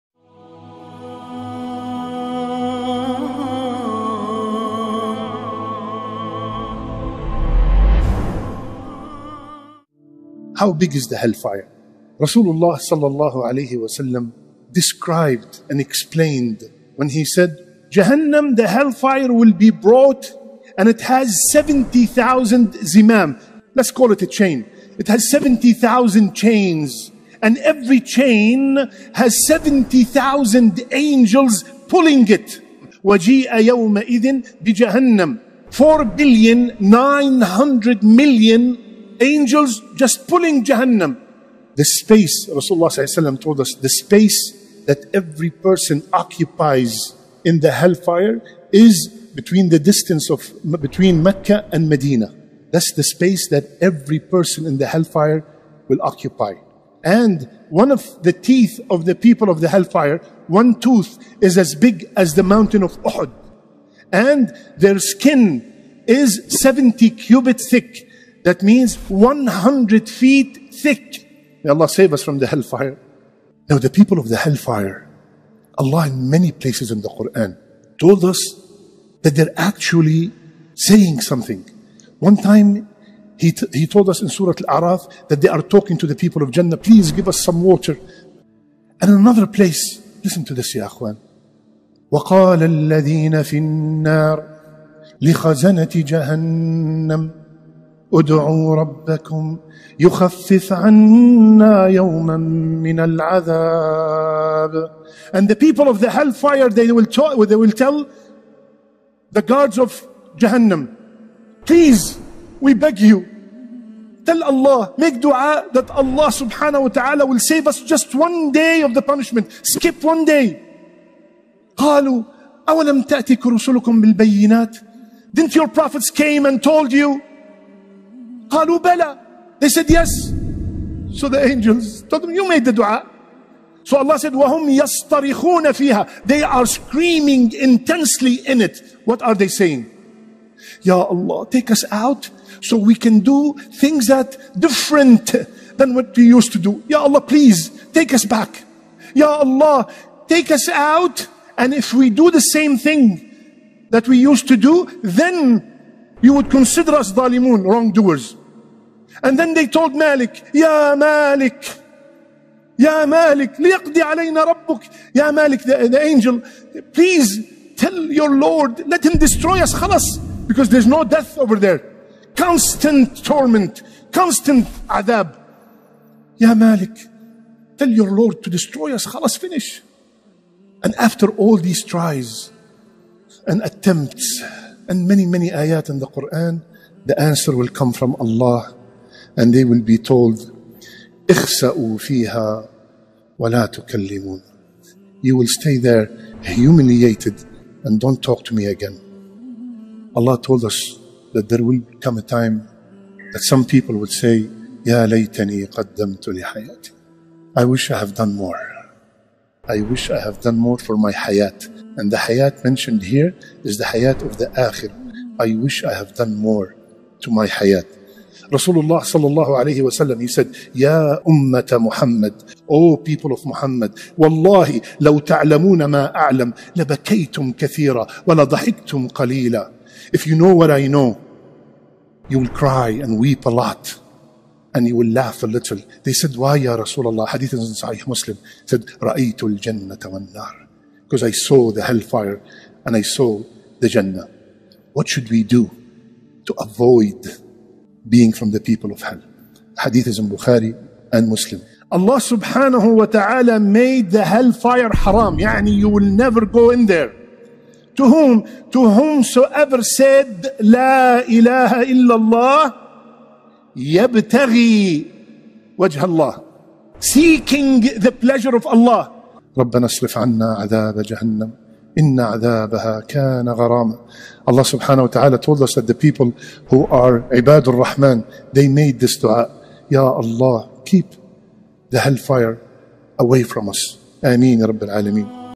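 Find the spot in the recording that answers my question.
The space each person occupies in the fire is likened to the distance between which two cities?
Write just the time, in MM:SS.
00:50.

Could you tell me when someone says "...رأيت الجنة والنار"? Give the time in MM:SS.
03:59.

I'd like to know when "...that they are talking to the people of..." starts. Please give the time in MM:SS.
01:25.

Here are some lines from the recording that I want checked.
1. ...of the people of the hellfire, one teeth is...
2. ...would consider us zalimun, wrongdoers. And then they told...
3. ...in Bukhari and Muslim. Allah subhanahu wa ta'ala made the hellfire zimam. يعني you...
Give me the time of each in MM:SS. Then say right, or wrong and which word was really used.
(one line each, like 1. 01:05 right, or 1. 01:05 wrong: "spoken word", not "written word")
1. 00:58 wrong: "tooth", not "teeth"
2. 02:36 right
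3. 04:10 wrong: "haram", not "zimam".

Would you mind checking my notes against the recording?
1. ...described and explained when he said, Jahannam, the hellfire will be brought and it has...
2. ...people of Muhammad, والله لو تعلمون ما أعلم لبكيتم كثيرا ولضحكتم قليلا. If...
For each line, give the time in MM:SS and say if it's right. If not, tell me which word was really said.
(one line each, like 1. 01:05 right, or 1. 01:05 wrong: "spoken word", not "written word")
1. 00:14 right
2. 03:42 right.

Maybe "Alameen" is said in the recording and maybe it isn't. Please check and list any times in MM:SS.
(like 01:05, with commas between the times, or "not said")
04:44.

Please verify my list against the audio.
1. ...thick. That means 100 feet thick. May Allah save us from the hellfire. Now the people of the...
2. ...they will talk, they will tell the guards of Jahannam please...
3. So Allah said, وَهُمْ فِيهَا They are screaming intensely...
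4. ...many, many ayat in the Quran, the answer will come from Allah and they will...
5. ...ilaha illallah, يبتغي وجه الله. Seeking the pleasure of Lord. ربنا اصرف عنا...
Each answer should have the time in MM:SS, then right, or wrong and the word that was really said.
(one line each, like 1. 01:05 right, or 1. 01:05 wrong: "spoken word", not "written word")
1. 01:07 right
2. 01:46 right
3. 02:13 right
4. 03:05 right
5. 04:21 wrong: "Allah", not "Lord".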